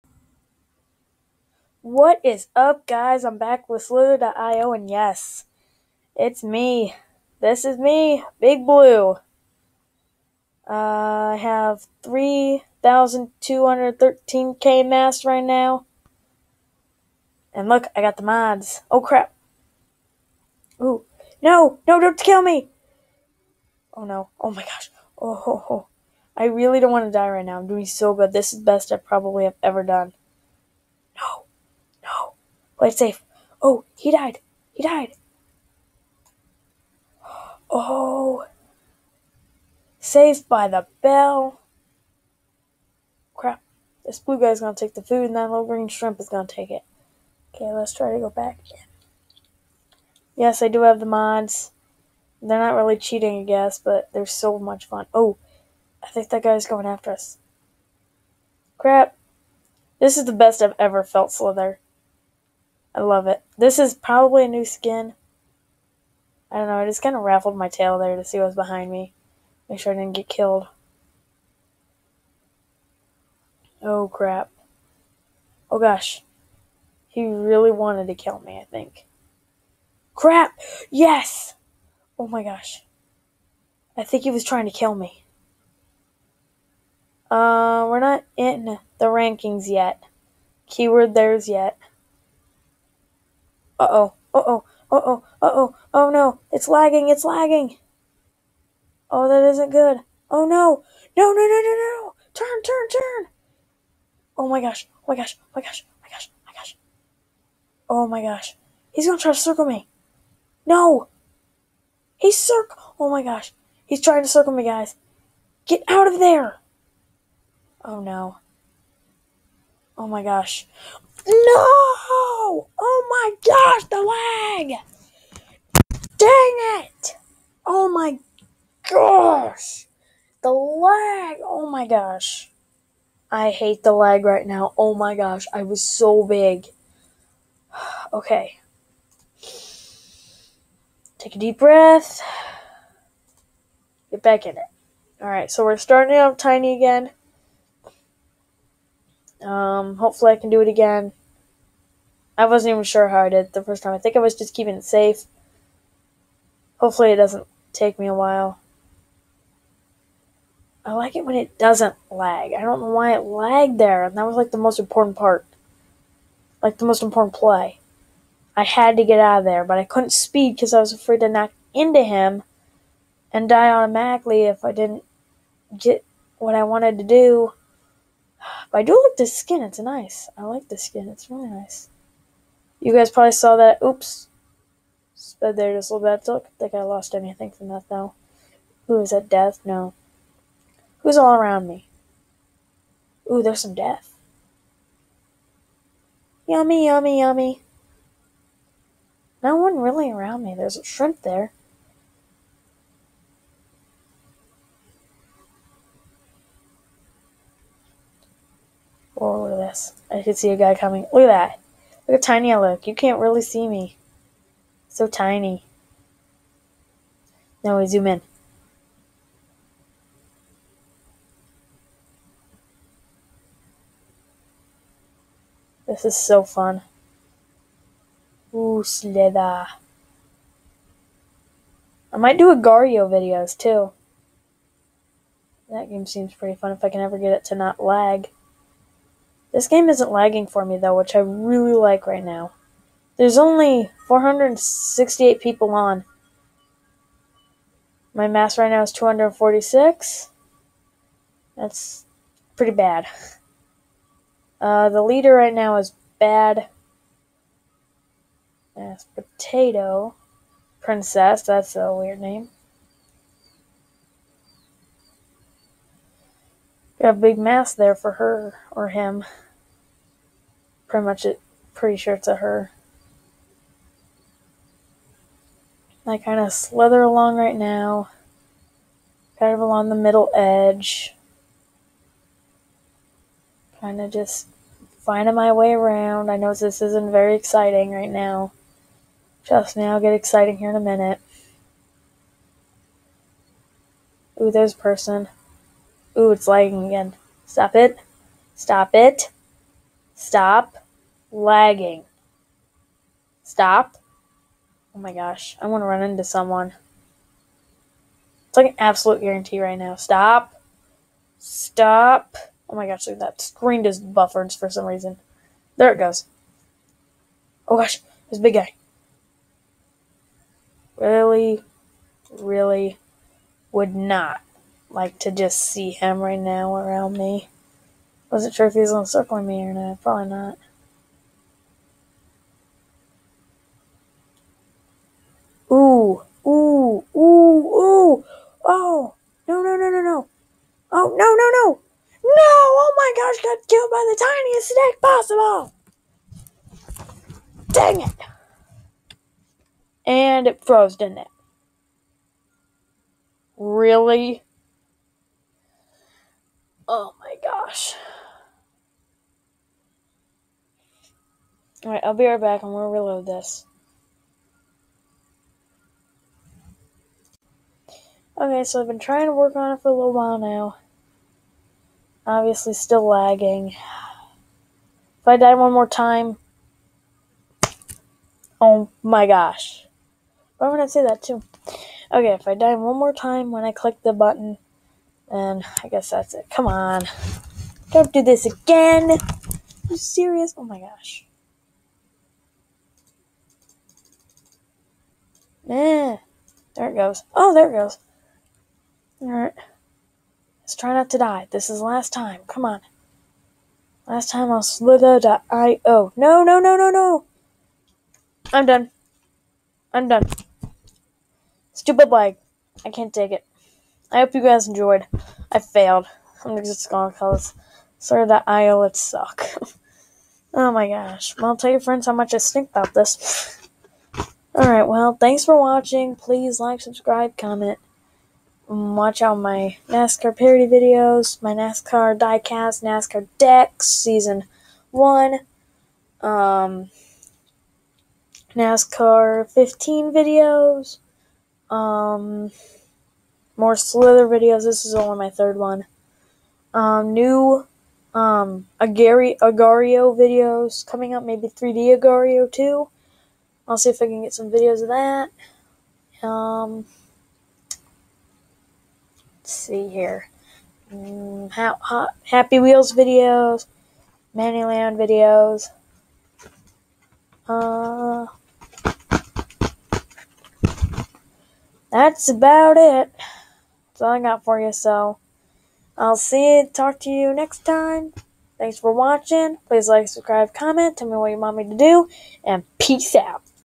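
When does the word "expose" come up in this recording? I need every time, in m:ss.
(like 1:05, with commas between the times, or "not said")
not said.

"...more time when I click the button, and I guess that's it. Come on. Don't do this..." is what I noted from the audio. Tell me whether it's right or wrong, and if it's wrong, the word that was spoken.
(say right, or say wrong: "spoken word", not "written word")
right.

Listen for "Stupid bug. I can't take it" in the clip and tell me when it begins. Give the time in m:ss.
6:51.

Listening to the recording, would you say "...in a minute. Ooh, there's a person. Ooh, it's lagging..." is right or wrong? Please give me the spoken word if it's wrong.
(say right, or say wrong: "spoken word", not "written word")
right.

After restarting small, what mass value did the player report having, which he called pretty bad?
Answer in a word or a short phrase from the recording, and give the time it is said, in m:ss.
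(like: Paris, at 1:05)
246, at 4:08.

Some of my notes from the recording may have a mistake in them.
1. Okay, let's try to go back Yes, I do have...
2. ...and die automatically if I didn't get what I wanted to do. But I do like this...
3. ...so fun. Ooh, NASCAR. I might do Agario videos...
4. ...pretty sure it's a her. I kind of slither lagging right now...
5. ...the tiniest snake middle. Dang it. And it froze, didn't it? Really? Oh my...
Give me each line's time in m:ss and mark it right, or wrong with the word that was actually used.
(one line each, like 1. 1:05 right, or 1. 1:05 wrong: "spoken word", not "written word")
1. 0:47 right
2. 2:53 right
3. 3:46 wrong: "Slither", not "NASCAR"
4. 4:31 wrong: "along", not "lagging"
5. 5:46 wrong: "possible", not "middle".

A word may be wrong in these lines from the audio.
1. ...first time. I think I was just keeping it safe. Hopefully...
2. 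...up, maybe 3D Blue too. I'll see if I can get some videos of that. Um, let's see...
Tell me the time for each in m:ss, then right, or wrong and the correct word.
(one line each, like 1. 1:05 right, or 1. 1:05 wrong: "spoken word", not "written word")
1. 2:33 right
2. 7:31 wrong: "Agario", not "Blue".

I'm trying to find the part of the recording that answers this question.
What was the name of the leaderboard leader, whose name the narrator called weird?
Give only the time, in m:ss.
4:19.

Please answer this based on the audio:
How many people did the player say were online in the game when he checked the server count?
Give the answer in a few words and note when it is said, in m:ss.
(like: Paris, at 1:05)
468, at 4:04.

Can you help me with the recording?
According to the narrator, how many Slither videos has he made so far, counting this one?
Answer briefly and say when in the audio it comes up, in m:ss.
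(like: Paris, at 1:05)
3, at 7:25.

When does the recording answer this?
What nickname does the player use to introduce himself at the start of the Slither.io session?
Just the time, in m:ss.
0:08.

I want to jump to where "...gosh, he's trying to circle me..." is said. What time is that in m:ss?
1:53.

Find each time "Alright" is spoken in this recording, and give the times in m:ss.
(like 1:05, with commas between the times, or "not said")
2:25, 6:01, 6:39, 7:04.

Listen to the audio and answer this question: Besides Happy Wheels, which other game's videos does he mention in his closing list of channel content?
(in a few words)
Manyland.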